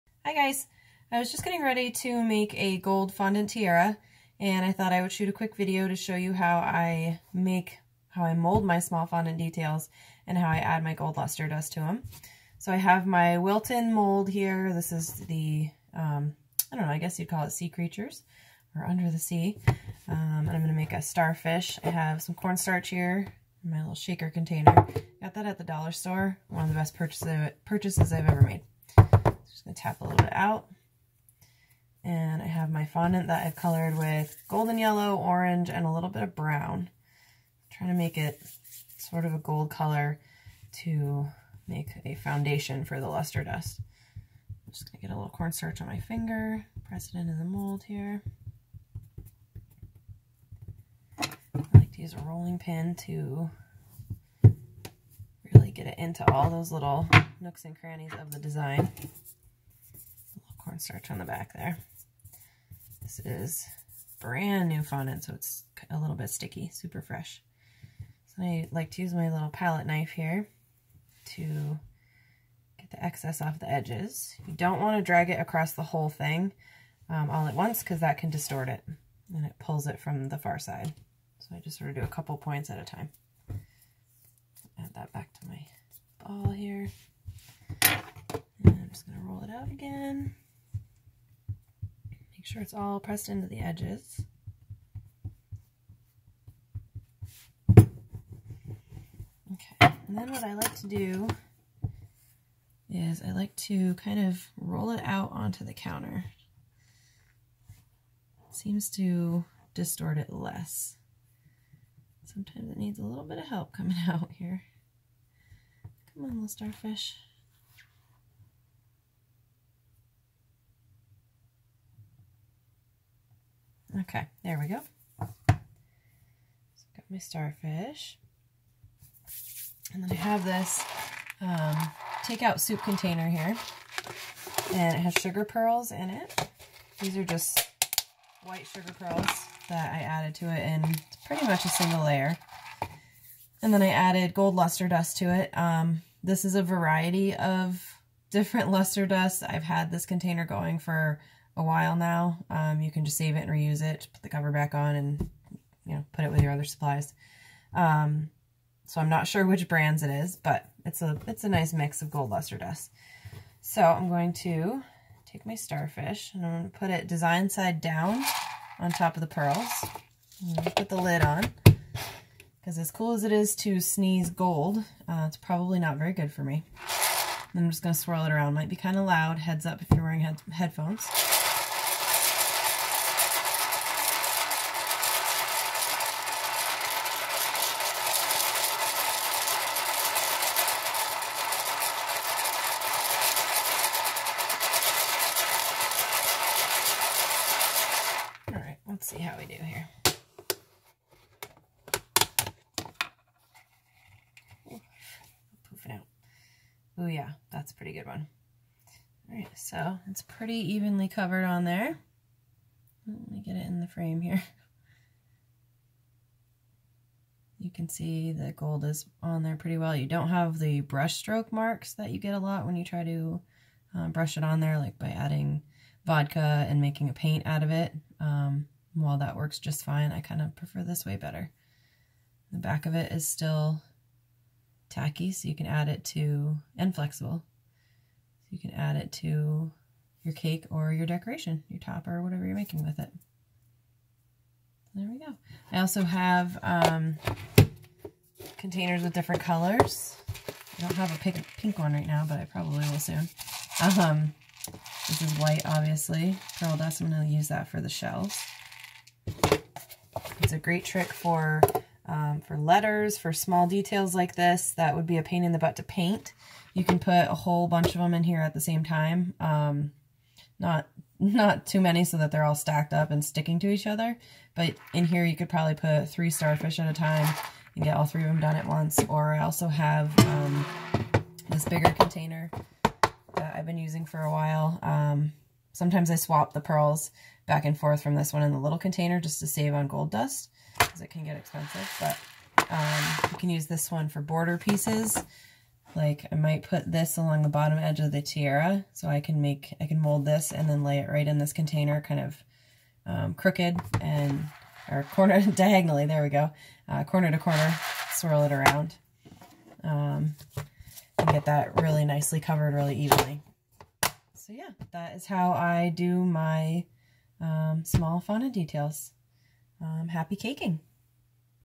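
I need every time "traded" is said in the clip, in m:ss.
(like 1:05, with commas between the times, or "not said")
not said.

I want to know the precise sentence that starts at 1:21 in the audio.
So I just sort of do a couple points at a time.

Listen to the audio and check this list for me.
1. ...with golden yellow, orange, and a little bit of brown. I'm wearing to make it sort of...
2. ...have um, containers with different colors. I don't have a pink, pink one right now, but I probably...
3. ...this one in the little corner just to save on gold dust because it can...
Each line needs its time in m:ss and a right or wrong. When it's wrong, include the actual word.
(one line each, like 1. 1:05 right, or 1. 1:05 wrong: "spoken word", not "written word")
1. 0:33 wrong: "trying", not "wearing"
2. 4:06 right
3. 4:48 wrong: "container", not "corner".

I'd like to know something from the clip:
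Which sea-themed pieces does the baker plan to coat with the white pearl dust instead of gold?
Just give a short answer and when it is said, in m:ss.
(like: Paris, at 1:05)
the shells, at 4:17.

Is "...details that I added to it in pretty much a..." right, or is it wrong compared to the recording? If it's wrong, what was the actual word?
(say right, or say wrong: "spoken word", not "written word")
wrong: "pearls", not "details".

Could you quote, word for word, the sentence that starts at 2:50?
put the lid on because as cool as it is to sneeze gold, uh, it's probably not very good for me.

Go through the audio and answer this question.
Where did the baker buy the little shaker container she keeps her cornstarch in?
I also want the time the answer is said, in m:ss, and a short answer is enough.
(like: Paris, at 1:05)
the dollar store, at 0:25.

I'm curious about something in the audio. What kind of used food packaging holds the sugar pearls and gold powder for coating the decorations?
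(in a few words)
takeout soup container.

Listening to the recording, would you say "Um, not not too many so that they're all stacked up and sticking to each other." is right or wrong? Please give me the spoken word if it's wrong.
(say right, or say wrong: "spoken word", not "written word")
right.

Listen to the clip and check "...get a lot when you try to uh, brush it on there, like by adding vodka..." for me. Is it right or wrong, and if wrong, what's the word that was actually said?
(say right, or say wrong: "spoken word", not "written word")
right.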